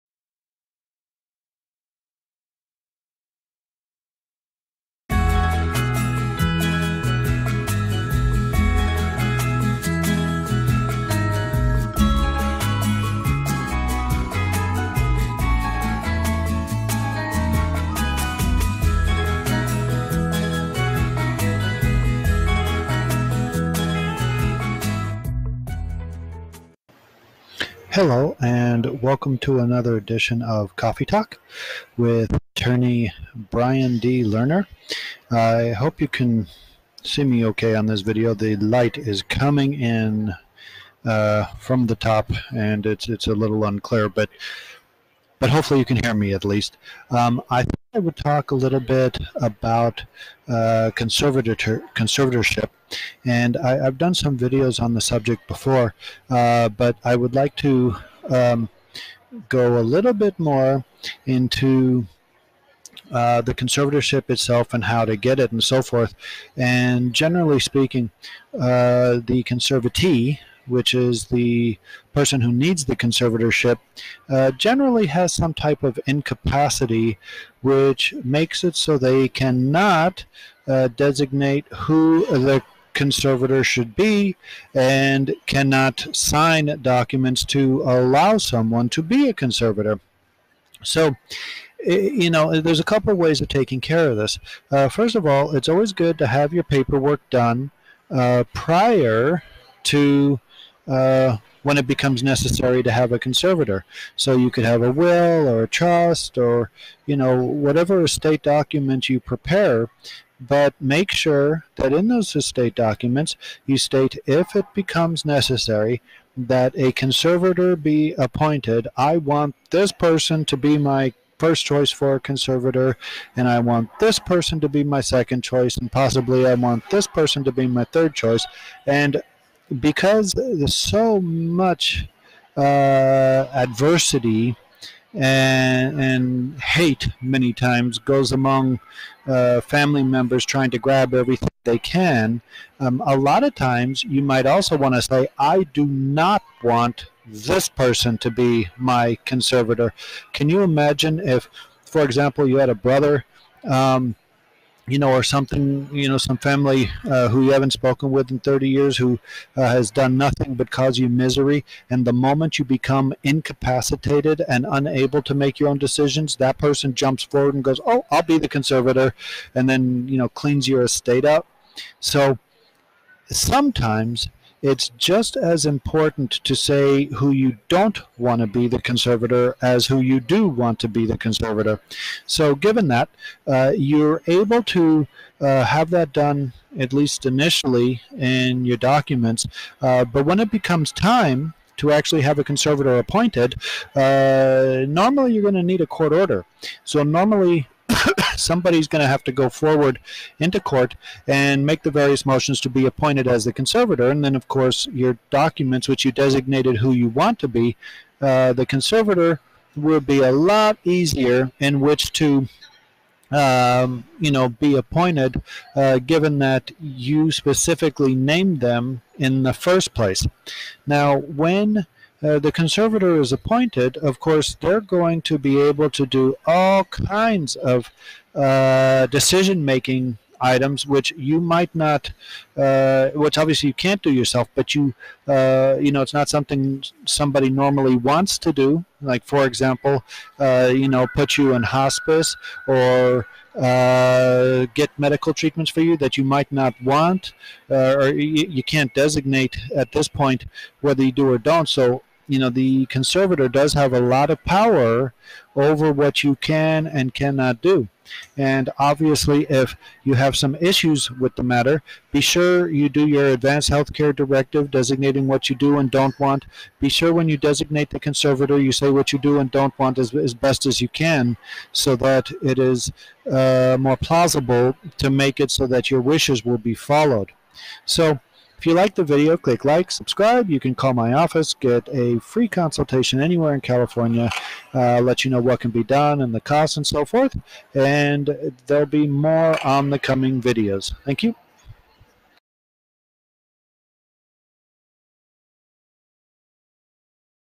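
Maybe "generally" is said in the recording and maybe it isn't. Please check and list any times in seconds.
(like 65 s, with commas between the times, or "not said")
67 s, 74 s.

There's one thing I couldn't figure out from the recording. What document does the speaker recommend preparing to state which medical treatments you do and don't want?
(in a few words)
advanced healthcare directive.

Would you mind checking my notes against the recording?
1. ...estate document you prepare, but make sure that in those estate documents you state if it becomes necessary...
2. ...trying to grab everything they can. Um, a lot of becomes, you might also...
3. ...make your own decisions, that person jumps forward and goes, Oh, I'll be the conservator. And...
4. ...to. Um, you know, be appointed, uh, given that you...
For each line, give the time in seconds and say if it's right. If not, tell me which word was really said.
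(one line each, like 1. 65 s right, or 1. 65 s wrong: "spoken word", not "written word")
1. 108 s right
2. 140 s wrong: "times", not "becomes"
3. 165 s right
4. 212 s right.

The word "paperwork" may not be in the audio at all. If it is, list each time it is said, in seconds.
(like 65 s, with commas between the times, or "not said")
96 s.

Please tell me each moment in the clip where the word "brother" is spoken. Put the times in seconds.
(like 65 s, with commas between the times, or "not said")
152 s.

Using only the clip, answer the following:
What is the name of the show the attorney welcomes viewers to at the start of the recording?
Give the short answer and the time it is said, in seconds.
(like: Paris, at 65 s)
Coffee Talk, at 30 s.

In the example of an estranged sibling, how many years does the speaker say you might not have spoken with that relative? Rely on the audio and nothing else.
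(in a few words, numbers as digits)
30.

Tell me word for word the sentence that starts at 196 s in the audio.
So normally somebody's going to have to go forward into court and make the various motions to be appointed as the conservator.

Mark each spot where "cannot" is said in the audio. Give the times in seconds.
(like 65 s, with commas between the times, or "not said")
79 s, 85 s, 257 s.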